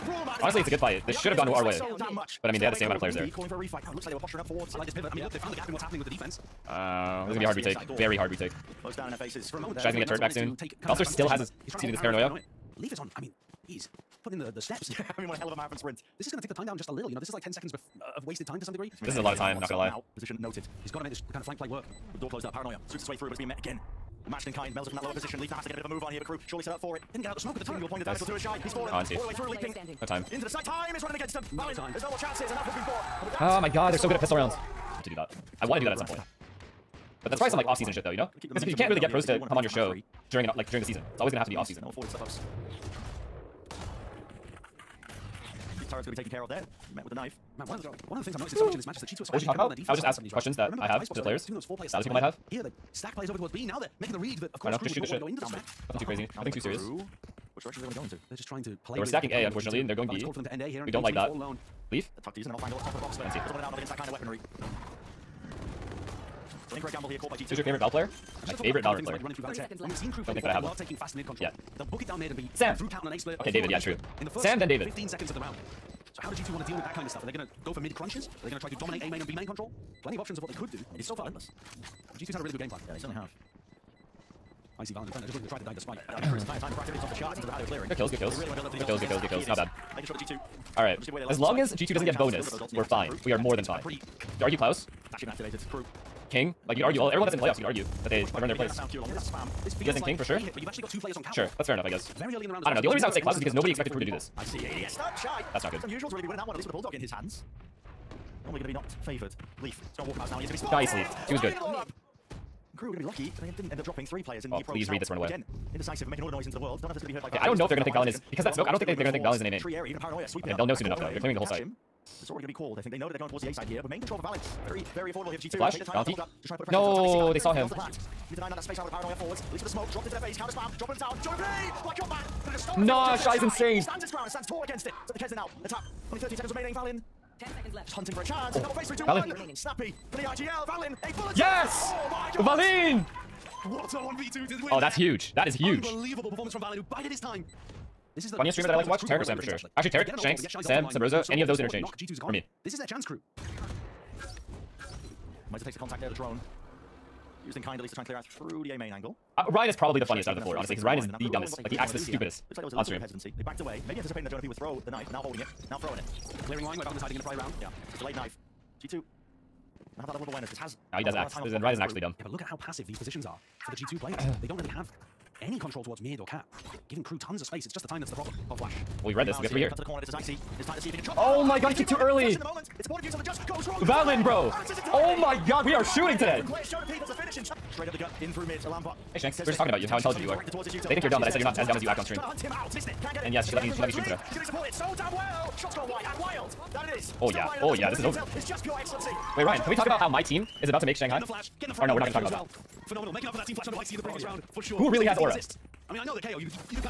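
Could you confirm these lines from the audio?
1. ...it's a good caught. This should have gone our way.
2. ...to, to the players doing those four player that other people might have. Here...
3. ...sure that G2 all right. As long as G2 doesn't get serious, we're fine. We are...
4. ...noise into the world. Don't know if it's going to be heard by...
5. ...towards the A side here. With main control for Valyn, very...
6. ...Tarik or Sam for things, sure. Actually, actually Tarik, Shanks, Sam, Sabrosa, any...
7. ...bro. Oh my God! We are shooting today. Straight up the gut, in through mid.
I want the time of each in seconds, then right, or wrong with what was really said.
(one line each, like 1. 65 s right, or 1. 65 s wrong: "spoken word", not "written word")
1. 0 s wrong: "fight", not "caught"
2. 51 s right
3. 90 s wrong: "bonus", not "serious"
4. 116 s right
5. 123 s right
6. 149 s right
7. 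184 s right.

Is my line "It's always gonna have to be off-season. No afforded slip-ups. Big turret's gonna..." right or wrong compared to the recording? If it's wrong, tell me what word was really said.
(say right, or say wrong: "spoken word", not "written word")
right.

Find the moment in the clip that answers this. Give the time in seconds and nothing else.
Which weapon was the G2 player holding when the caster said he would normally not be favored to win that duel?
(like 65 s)
106 s.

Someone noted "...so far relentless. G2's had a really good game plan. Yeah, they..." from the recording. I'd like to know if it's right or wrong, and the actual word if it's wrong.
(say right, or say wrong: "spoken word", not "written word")
right.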